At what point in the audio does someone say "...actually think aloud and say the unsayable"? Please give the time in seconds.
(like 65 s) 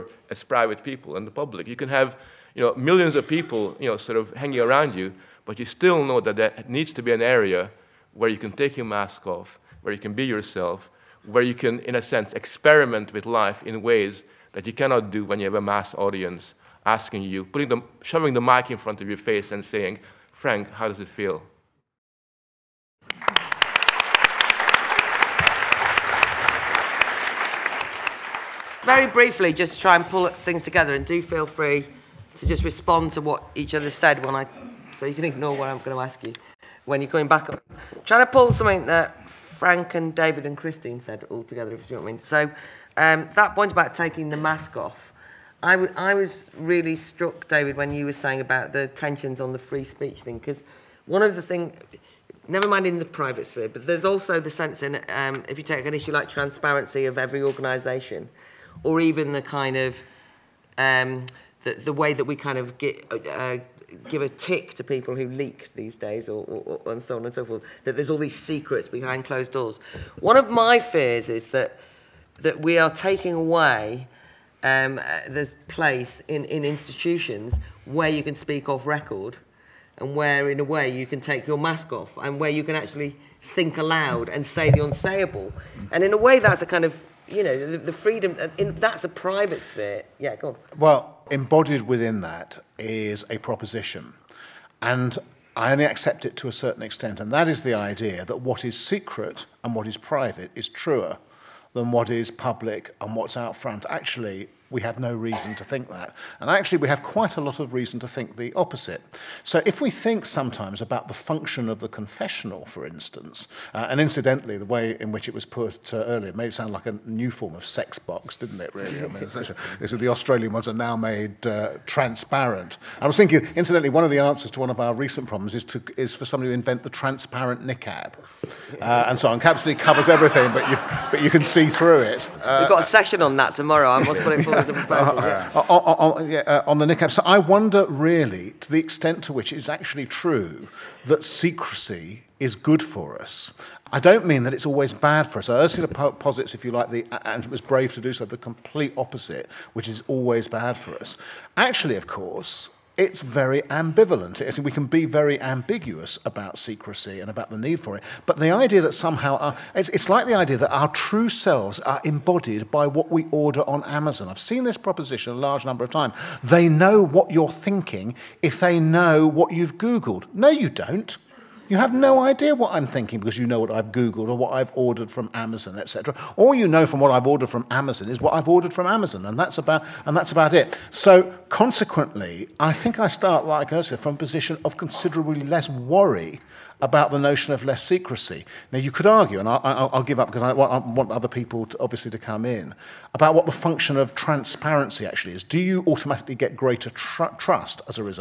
82 s.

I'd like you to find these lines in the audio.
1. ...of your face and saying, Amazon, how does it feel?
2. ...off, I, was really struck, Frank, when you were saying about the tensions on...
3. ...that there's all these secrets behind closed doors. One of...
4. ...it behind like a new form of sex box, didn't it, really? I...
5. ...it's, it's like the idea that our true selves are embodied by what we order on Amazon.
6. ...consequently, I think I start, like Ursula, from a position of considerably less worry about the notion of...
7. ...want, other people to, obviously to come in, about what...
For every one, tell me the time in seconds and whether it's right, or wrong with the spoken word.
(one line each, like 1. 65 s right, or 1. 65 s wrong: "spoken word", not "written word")
1. 19 s wrong: "Frank", not "Amazon"
2. 44 s wrong: "David", not "Frank"
3. 67 s right
4. 116 s wrong: "sound", not "behind"
5. 159 s right
6. 181 s right
7. 190 s right.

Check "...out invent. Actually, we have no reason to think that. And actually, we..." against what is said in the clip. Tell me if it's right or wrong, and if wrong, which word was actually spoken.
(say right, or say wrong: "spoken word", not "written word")
wrong: "front", not "invent".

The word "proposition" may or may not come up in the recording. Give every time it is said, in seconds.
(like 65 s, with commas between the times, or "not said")
93 s, 164 s.